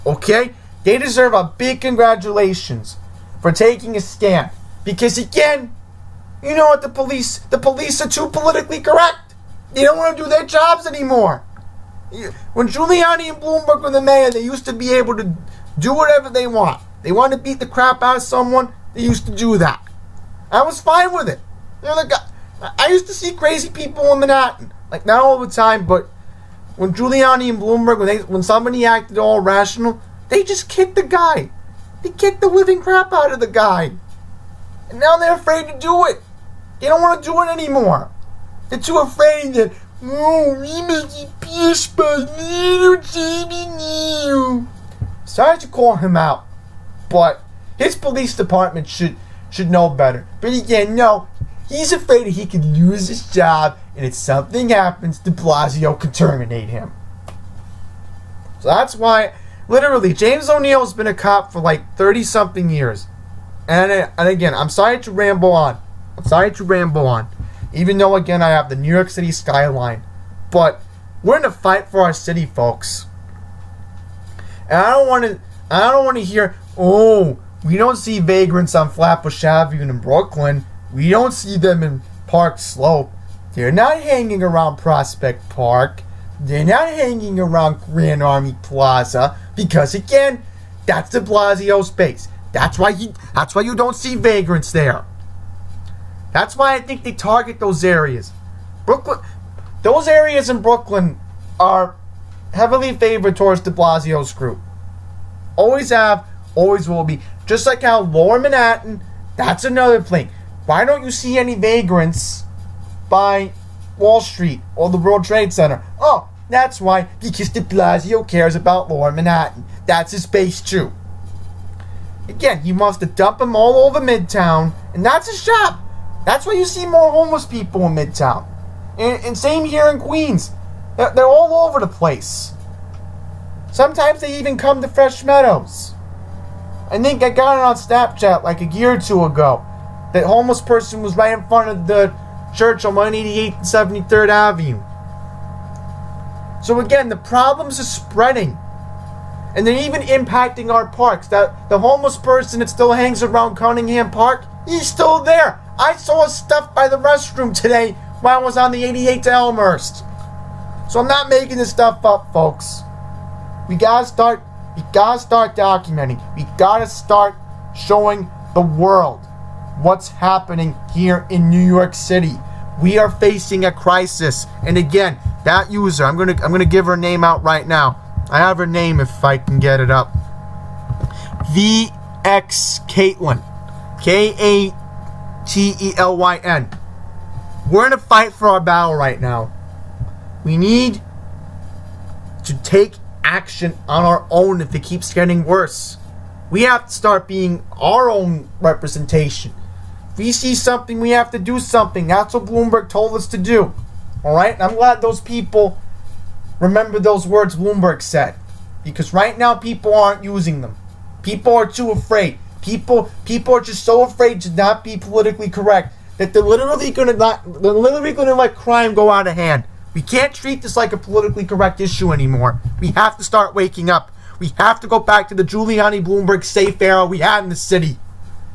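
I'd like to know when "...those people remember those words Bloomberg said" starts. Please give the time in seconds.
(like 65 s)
205 s.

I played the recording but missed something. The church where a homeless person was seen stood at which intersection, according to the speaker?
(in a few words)
188th and 73rd Avenue.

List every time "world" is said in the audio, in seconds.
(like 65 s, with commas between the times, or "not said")
114 s, 168 s.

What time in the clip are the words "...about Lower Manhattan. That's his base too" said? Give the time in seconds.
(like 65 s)
118 s.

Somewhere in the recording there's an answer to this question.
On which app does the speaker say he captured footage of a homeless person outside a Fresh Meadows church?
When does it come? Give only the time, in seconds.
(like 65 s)
137 s.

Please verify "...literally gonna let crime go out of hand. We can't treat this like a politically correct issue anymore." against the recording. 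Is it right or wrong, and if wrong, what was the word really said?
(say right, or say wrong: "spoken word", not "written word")
right.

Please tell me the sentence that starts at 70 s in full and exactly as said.
But we're in a fight for our city, folks.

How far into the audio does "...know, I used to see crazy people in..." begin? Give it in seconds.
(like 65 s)
21 s.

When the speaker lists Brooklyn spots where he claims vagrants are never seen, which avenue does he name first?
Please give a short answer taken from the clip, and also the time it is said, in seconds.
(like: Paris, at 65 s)
Flatbush Avenue, at 78 s.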